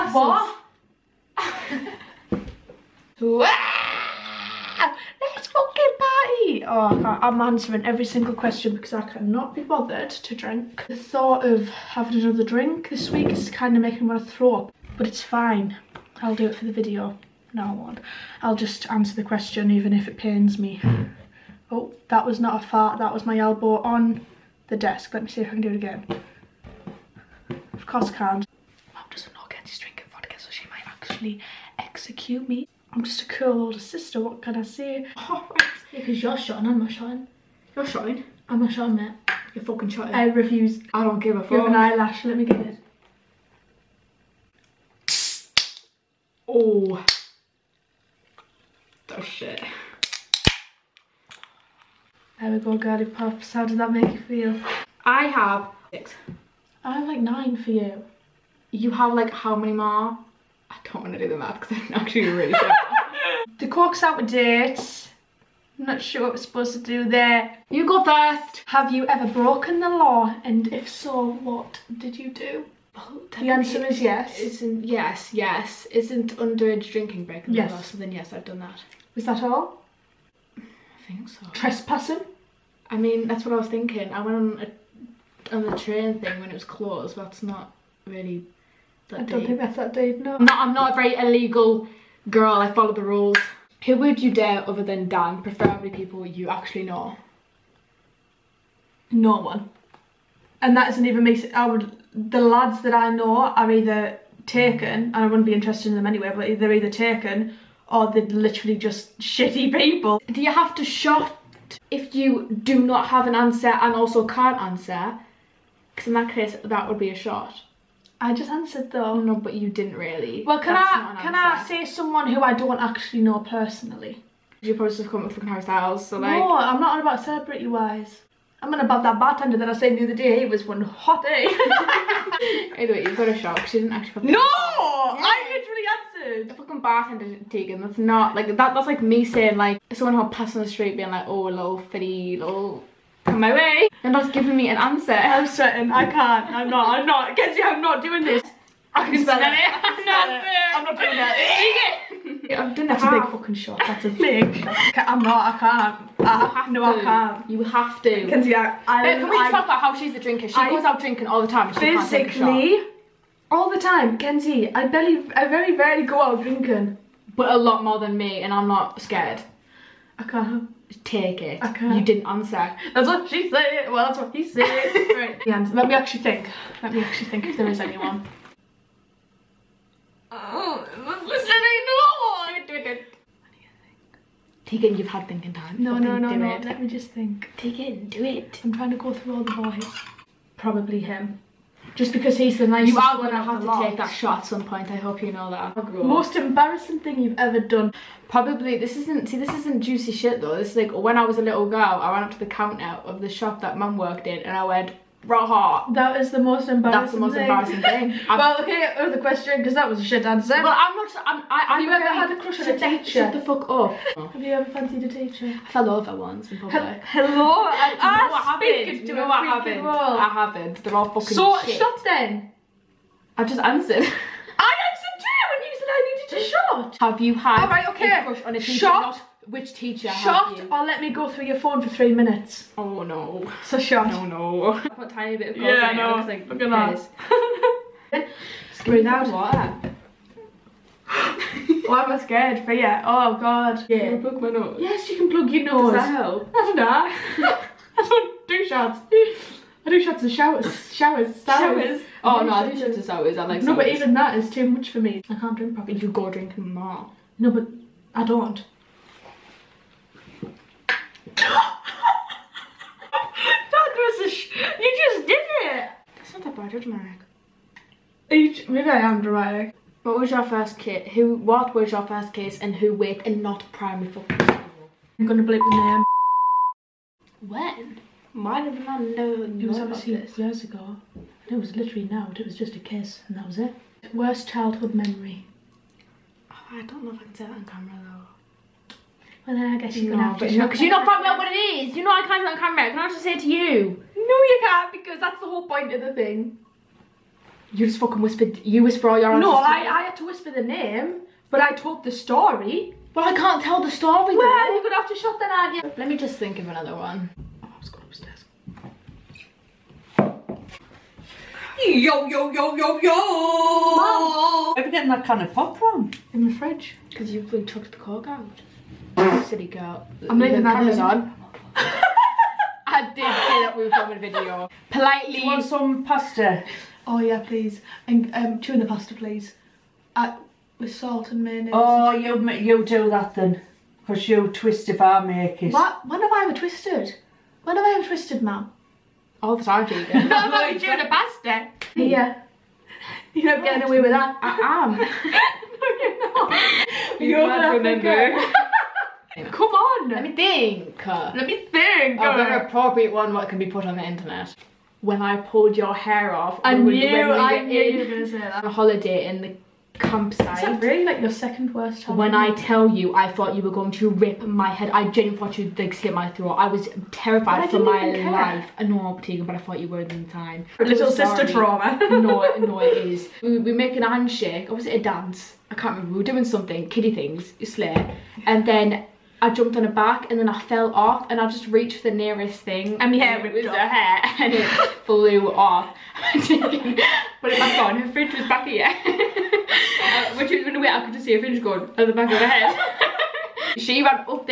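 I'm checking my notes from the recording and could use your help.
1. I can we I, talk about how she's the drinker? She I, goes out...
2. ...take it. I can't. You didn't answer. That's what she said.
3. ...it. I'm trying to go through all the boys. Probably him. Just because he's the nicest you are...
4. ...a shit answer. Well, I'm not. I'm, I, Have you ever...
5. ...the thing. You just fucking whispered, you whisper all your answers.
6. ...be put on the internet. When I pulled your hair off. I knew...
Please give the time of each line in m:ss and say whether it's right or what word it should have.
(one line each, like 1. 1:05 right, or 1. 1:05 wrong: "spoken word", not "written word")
1. 2:38 right
2. 2:51 right
3. 3:08 right
4. 3:29 right
5. 4:56 right
6. 5:53 right.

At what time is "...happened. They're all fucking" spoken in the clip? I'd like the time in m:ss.
3:40.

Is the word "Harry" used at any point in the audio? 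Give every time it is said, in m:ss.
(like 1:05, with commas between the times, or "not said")
2:05.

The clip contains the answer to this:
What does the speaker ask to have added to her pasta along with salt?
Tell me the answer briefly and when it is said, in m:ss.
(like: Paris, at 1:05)
Mayonnaise, at 5:31.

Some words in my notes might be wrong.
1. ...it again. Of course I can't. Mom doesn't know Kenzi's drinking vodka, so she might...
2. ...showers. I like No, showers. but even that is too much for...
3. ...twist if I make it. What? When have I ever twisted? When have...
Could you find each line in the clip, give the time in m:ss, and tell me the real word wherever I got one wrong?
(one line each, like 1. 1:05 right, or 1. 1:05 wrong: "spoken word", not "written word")
1. 0:25 right
2. 4:13 right
3. 5:34 right.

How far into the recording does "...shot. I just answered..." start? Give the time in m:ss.
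1:57.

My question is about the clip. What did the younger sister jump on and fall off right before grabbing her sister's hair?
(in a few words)
A bike.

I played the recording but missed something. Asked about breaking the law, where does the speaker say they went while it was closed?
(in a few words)
The train thing.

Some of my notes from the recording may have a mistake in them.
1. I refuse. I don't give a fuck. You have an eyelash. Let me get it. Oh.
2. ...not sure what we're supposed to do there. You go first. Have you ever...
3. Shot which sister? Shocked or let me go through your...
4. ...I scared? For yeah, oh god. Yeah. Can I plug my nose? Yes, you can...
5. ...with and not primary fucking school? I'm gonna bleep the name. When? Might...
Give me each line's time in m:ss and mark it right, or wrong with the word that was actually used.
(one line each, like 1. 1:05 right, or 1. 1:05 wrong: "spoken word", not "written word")
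1. 0:40 right
2. 1:05 right
3. 3:48 wrong: "teacher", not "sister"
4. 4:02 right
5. 4:32 right.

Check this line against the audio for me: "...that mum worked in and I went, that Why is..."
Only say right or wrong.
wrong.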